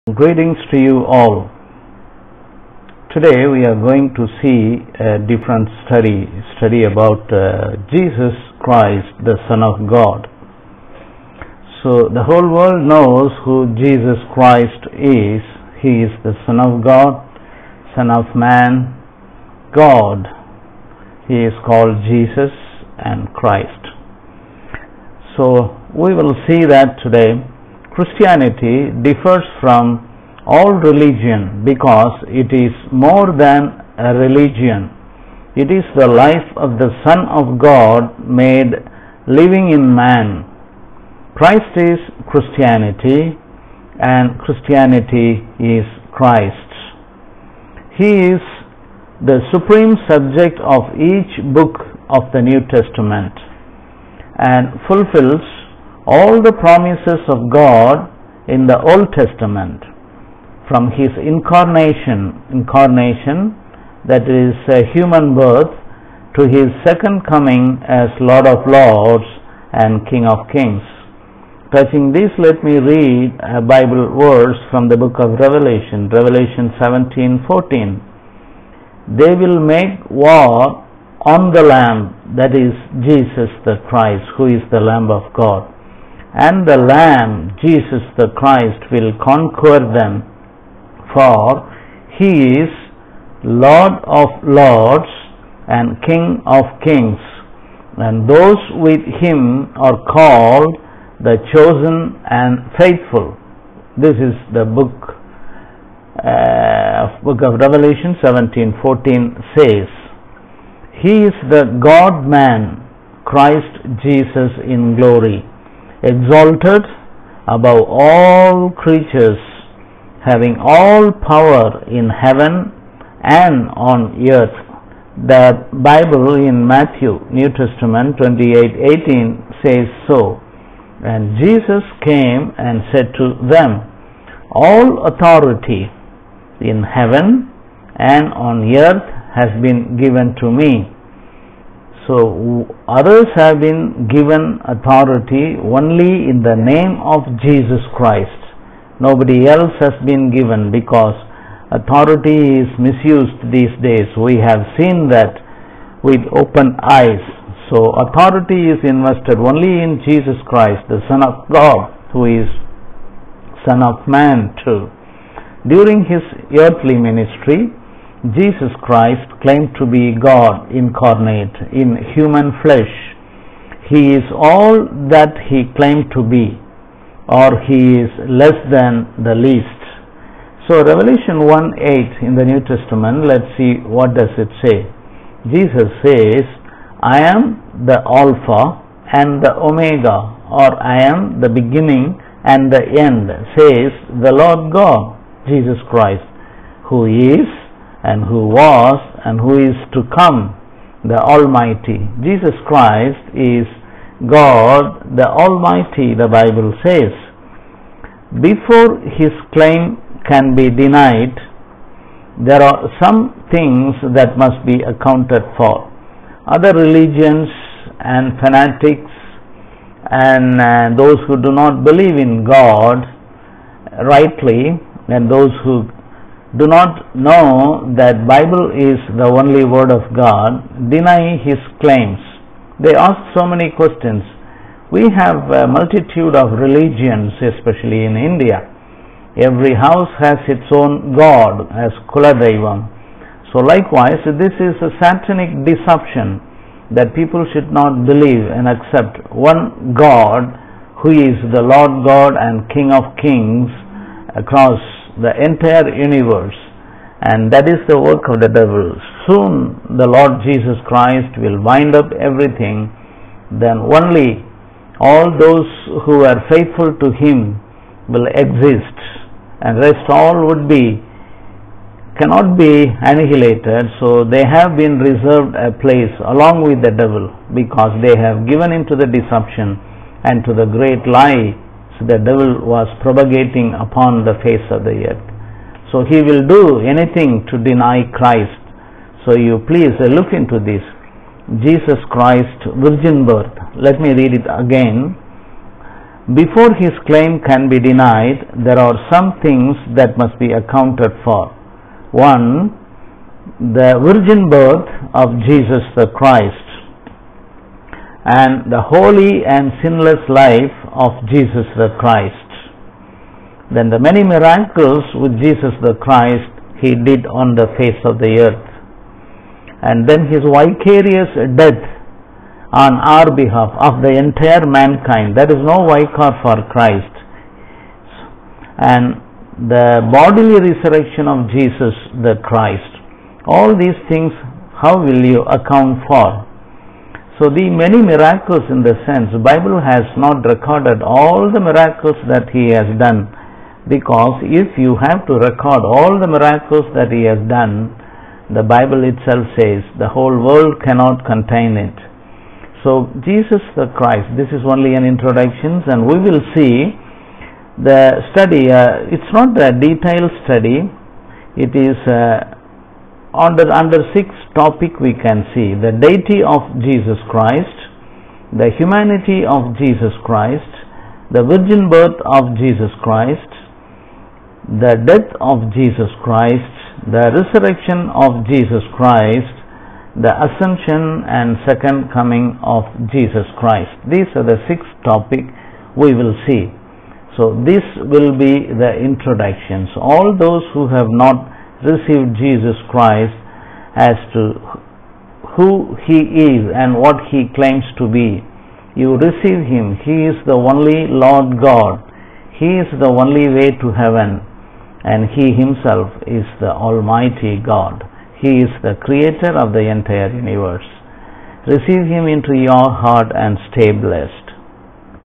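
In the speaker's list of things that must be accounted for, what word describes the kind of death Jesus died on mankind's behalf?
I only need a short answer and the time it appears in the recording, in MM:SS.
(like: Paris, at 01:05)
Vicarious, at 05:20.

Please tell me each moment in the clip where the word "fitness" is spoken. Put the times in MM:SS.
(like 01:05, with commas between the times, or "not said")
not said.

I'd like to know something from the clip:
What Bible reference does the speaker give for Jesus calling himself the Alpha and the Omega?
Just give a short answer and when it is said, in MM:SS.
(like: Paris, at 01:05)
Revelation 1:8, at 03:00.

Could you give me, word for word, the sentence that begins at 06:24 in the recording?
These are the six topic we will see.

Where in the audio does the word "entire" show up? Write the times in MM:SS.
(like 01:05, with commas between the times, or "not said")
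04:15, 05:24, 06:49.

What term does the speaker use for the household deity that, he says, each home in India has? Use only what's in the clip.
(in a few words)
Kuladaivam.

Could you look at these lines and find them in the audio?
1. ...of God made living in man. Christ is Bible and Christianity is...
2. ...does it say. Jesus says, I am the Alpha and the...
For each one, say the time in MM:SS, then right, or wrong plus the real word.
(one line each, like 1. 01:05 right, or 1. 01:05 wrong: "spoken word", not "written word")
1. 00:37 wrong: "Christianity", not "Bible"
2. 03:04 right.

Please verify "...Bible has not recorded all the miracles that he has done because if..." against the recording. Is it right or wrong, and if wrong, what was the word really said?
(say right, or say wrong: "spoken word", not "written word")
right.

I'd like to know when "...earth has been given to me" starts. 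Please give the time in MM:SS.
02:18.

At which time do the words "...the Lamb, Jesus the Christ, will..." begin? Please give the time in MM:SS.
01:26.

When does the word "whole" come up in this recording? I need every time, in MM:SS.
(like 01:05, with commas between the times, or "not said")
00:12, 05:50.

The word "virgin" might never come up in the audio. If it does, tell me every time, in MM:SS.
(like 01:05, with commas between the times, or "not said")
04:52, 05:04, 06:11.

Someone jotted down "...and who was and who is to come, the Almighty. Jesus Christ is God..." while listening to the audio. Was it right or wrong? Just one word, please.
right.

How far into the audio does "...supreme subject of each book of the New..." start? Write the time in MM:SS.
00:49.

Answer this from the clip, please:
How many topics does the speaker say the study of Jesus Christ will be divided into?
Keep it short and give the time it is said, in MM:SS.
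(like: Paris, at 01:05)
6, at 06:04.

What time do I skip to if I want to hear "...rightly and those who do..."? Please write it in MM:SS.
03:44.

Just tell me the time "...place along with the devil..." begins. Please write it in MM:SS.
04:35.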